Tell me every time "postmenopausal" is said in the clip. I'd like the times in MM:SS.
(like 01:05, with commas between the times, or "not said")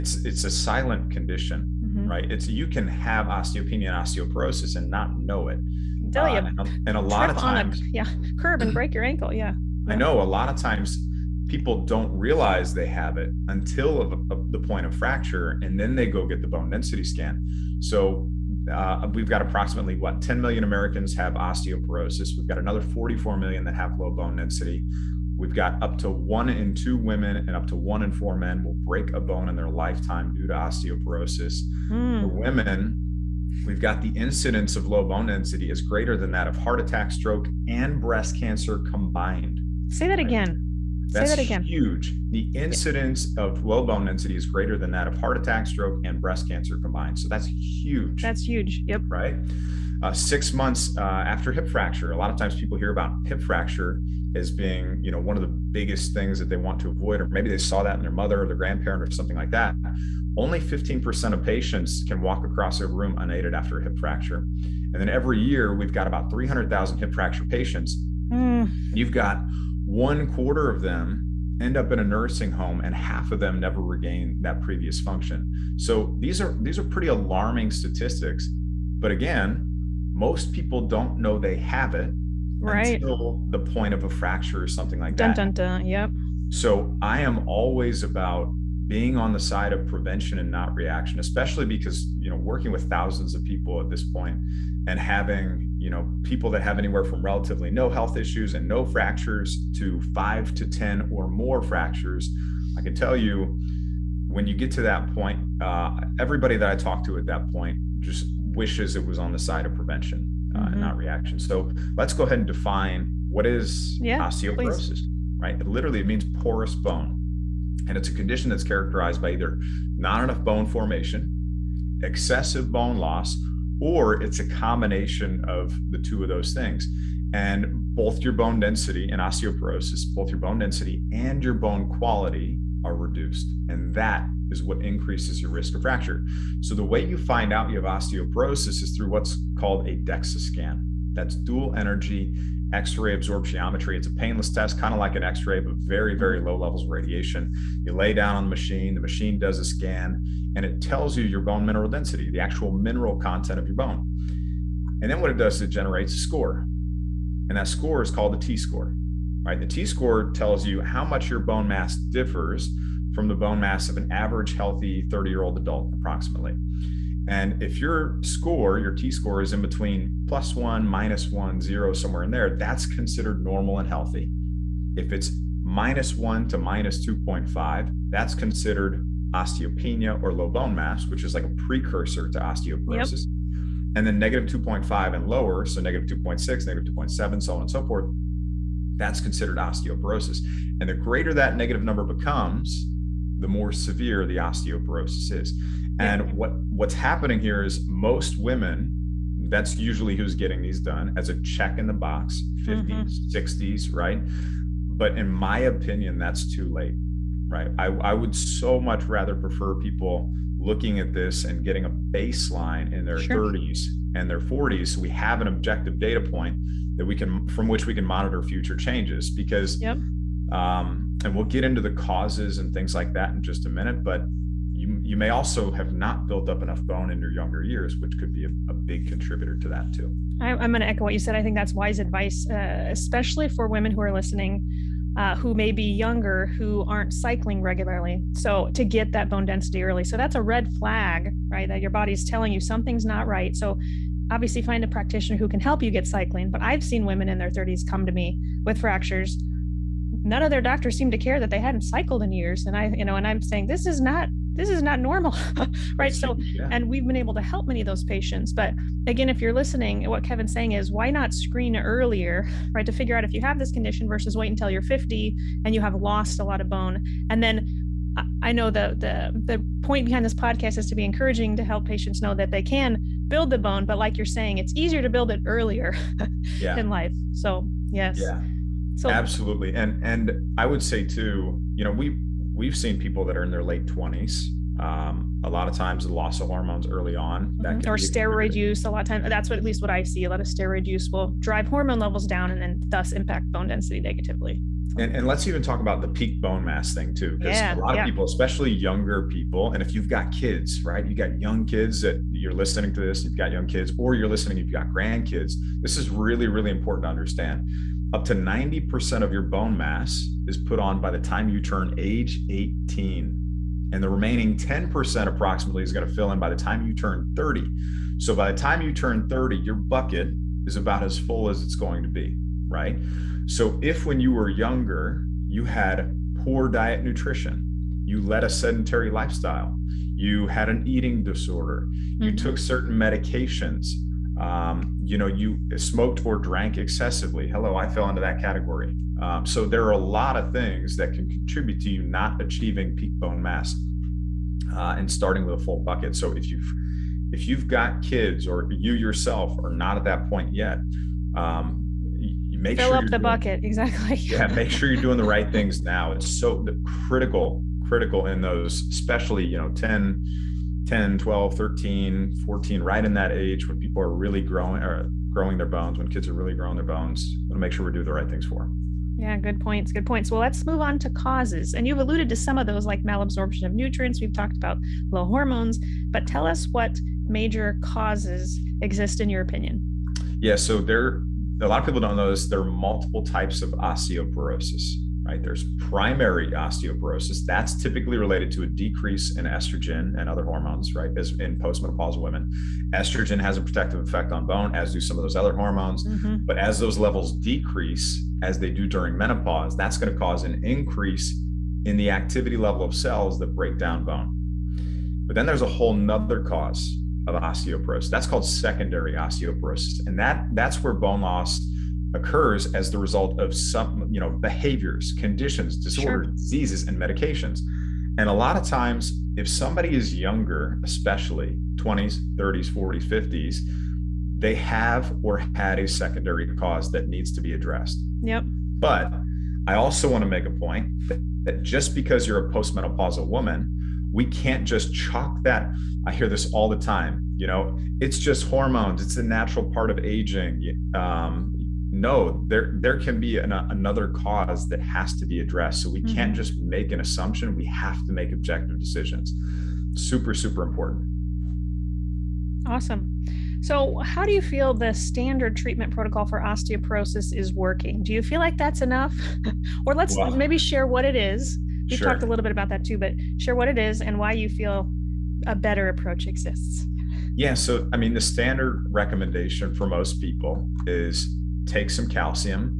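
06:31, 07:12.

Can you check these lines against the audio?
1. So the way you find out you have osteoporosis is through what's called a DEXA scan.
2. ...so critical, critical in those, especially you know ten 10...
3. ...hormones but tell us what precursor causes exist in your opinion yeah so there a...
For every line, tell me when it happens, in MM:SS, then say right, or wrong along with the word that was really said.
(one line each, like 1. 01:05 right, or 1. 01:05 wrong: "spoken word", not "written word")
1. 02:16 right
2. 05:56 right
3. 06:15 wrong: "major", not "precursor".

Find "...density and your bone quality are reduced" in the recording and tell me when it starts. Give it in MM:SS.
02:10.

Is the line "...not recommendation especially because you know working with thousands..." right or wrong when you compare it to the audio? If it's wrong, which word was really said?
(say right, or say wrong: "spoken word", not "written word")
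wrong: "reaction", not "recommendation".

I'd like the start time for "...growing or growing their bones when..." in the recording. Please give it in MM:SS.
06:04.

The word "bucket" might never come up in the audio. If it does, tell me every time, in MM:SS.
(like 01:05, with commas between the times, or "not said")
05:19, 05:45, 05:53.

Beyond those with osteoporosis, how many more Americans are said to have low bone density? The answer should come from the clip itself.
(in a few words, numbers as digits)
44 million.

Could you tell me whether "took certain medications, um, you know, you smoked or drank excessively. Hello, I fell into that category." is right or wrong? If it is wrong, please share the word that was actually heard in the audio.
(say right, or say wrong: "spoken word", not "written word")
right.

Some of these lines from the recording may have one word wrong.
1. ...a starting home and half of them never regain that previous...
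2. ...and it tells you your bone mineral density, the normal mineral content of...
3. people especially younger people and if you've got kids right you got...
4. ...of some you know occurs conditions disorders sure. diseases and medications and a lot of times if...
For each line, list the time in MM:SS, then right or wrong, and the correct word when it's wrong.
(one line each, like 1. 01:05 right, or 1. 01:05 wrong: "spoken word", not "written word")
1. 01:11 wrong: "nursing", not "starting"
2. 02:30 wrong: "actual", not "normal"
3. 04:58 right
4. 06:53 wrong: "behaviors", not "occurs".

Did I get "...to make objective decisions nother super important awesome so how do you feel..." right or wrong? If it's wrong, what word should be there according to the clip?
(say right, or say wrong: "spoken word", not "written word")
wrong: "super", not "nother".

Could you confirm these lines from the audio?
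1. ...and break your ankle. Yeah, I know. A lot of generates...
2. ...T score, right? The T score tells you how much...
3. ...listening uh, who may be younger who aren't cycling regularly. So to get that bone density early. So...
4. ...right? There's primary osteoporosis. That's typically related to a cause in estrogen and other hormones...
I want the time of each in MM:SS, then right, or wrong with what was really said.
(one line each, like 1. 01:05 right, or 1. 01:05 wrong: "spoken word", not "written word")
1. 00:08 wrong: "times", not "generates"
2. 02:38 right
3. 03:54 right
4. 06:25 wrong: "decrease", not "cause".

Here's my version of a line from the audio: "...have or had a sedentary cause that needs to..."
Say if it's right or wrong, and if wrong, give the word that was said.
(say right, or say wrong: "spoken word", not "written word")
wrong: "secondary", not "sedentary".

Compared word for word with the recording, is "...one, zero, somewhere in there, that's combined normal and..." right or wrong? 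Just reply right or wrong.
wrong.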